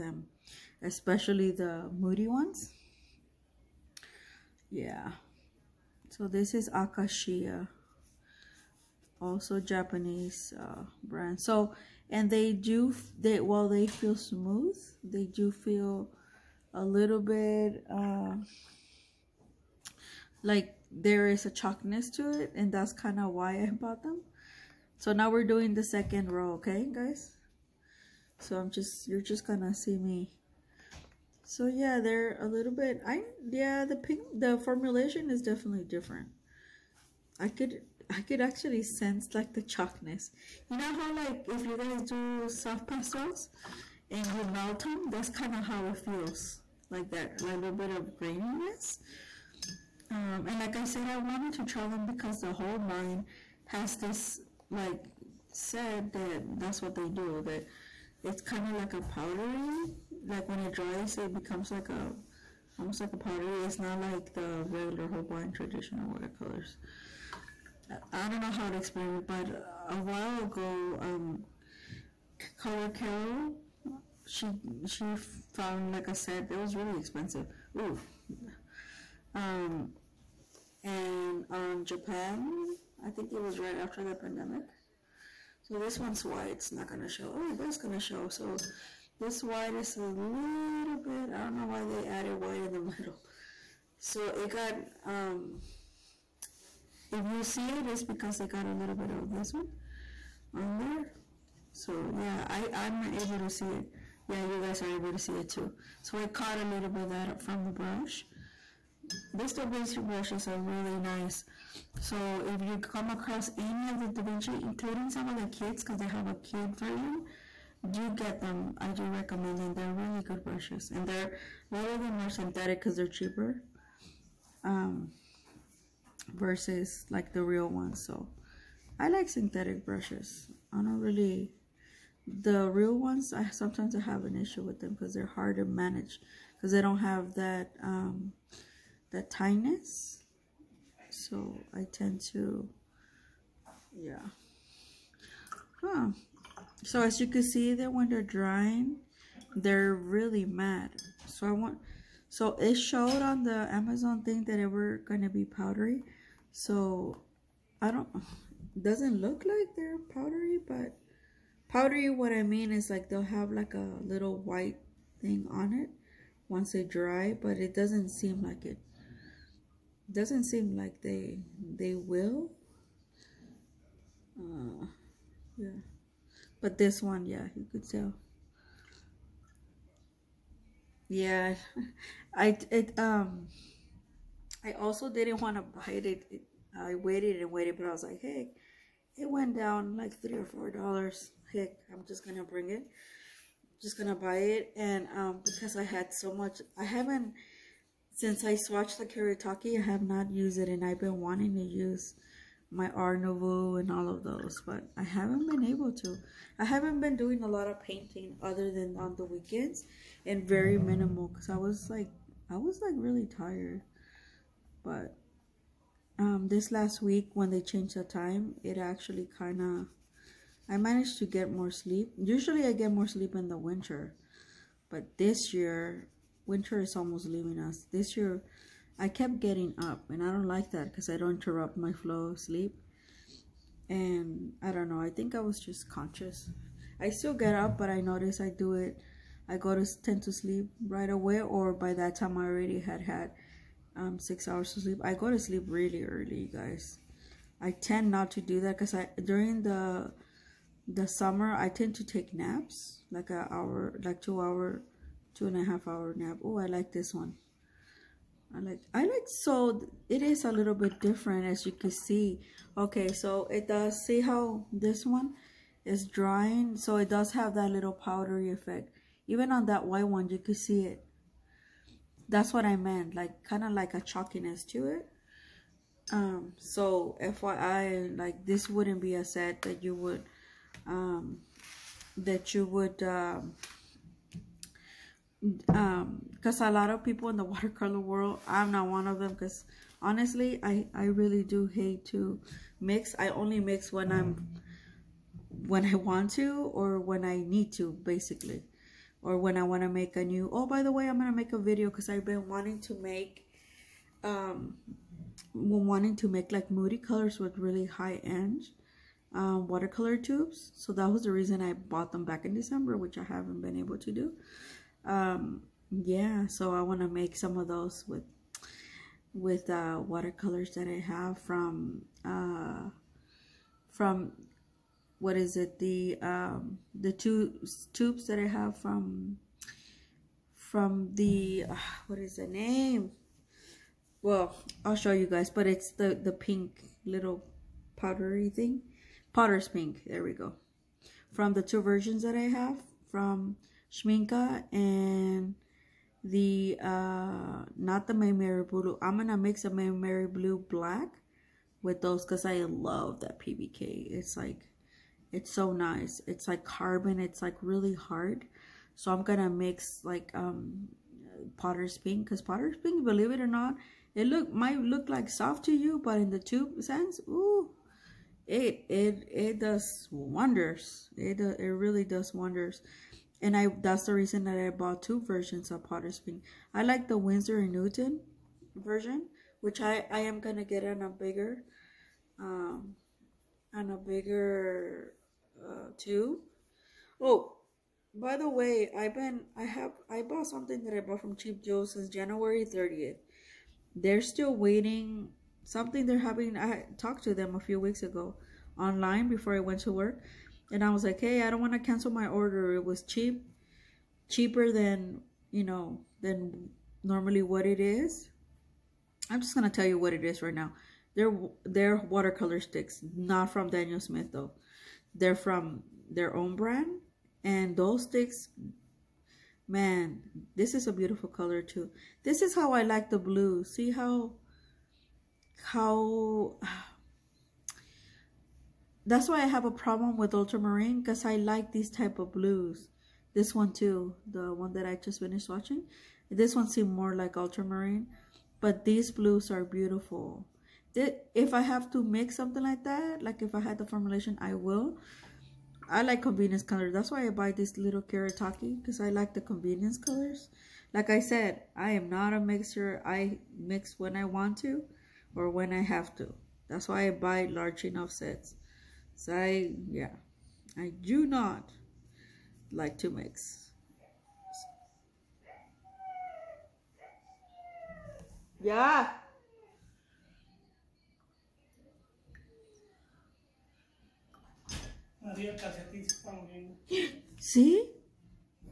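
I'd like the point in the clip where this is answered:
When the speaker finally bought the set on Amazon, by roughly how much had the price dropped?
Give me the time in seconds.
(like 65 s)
190 s.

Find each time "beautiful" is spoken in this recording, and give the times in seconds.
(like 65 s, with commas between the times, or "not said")
420 s, 439 s.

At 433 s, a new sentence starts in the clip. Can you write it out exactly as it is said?
This one too, the one that I just finished watching.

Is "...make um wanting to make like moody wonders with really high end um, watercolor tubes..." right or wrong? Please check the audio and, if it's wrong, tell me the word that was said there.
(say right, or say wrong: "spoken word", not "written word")
wrong: "colors", not "wonders".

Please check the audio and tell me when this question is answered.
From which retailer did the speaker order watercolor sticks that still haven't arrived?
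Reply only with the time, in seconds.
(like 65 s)
391 s.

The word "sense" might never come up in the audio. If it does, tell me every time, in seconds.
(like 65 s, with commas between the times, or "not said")
38 s, 366 s.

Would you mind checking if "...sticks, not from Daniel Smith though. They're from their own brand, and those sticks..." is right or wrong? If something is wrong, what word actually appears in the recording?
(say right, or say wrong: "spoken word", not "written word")
right.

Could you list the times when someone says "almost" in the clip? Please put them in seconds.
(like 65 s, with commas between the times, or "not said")
62 s, 226 s.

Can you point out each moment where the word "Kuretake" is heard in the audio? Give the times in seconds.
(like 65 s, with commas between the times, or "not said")
199 s, 448 s.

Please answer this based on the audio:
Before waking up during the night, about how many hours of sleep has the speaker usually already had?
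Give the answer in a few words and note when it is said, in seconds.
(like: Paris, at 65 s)
6, at 244 s.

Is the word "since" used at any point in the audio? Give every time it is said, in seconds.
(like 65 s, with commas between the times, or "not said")
198 s, 391 s.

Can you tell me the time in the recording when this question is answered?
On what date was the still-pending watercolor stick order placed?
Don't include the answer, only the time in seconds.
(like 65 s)
392 s.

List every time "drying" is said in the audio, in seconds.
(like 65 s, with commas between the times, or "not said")
148 s, 266 s.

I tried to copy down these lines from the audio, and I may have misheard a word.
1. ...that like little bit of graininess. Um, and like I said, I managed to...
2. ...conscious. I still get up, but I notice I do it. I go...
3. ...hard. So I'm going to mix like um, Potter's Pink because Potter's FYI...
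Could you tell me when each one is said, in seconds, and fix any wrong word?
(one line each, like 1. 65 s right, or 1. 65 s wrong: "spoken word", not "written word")
1. 47 s wrong: "wanted", not "managed"
2. 235 s right
3. 357 s wrong: "Pink", not "FYI".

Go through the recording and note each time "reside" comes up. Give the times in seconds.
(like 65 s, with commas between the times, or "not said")
not said.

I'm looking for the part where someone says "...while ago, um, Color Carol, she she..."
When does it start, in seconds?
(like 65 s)
69 s.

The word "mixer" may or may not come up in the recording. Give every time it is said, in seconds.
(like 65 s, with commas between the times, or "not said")
452 s.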